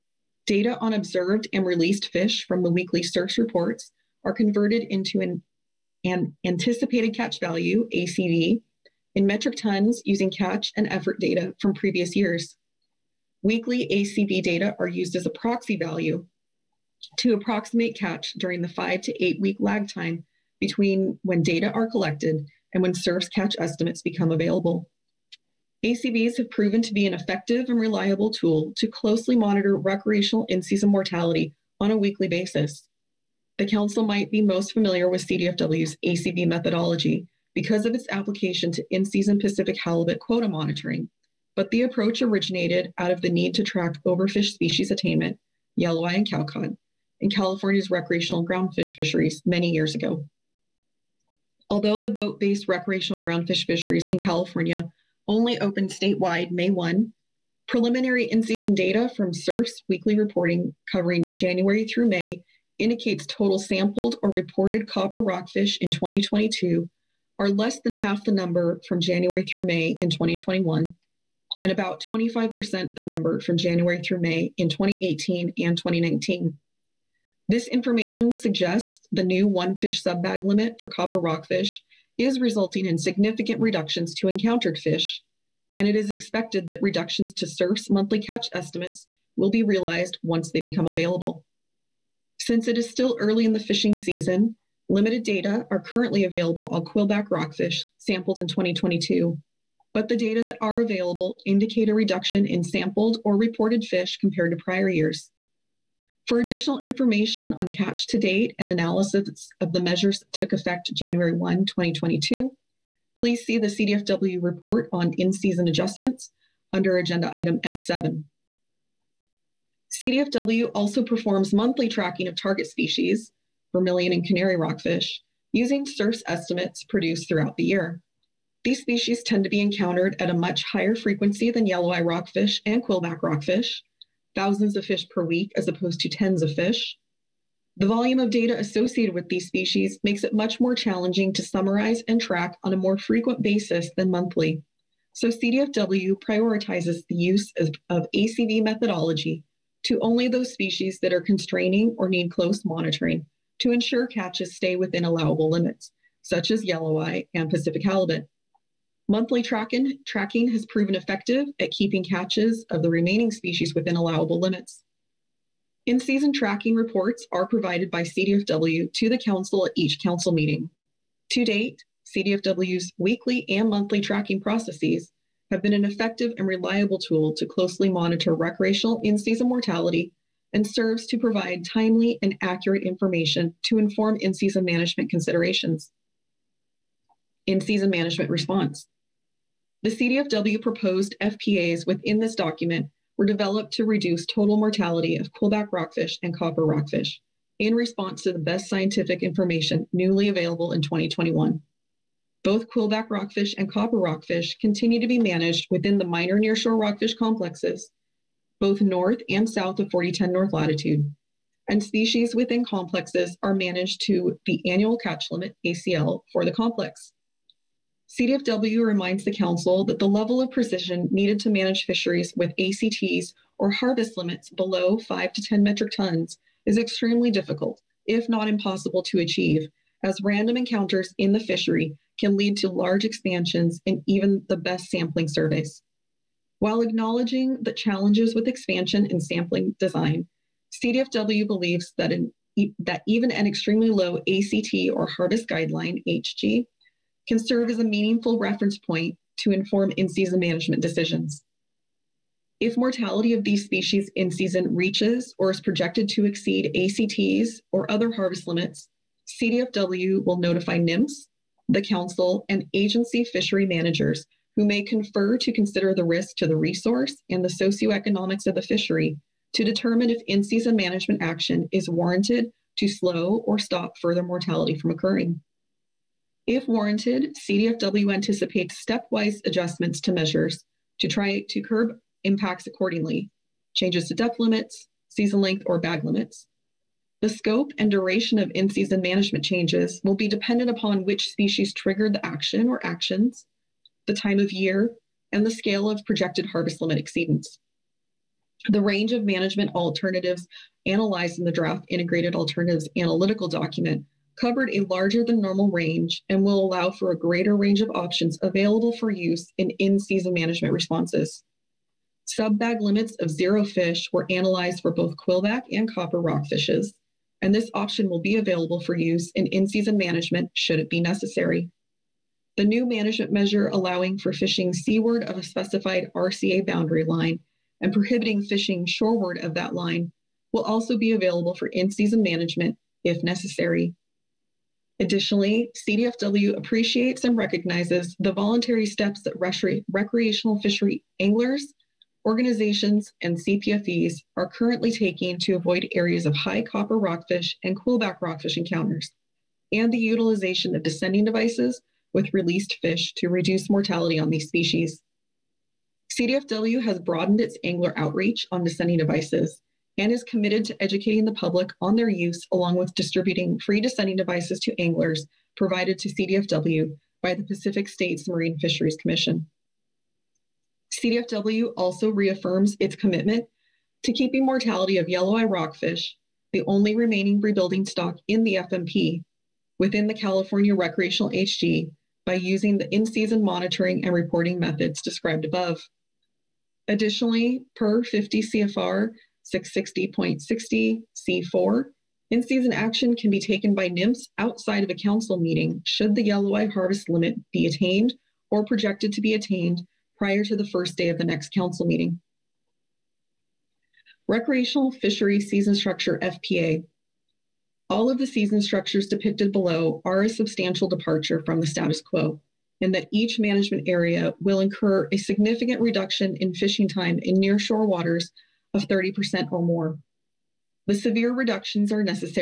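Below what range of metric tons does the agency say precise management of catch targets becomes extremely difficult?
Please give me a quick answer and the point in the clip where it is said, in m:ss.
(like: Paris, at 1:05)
5 to 10 metric tons, at 3:44.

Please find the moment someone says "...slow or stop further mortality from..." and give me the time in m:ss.
4:32.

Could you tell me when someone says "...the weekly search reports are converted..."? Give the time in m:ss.
0:02.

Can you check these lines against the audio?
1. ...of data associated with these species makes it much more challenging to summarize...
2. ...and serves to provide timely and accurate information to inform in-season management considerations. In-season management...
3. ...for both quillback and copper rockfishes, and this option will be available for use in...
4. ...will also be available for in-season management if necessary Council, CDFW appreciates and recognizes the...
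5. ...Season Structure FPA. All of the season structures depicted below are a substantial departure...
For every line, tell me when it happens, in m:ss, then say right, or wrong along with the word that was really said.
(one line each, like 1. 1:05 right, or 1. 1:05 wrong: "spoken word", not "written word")
1. 2:18 right
2. 3:00 right
3. 5:14 right
4. 5:30 wrong: "Additionally", not "Council"
5. 6:45 right.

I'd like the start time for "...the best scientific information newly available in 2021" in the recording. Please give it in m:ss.
3:18.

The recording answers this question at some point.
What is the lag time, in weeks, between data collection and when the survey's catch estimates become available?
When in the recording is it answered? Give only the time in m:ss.
0:18.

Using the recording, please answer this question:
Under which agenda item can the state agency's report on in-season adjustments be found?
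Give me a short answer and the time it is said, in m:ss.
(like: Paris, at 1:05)
F7, at 1:57.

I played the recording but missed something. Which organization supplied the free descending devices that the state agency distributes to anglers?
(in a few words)
Pacific States Marine Fisheries Commission.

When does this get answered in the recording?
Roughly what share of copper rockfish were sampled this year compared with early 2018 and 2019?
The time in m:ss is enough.
1:12.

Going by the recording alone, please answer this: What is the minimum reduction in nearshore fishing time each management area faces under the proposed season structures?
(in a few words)
30%.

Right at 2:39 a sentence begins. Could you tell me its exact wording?
Monthly tracking, tracking has proven effective at keeping catches of the remaining species within allowable limits.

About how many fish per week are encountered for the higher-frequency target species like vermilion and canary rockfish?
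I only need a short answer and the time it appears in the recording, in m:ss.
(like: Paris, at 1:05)
thousands, at 2:14.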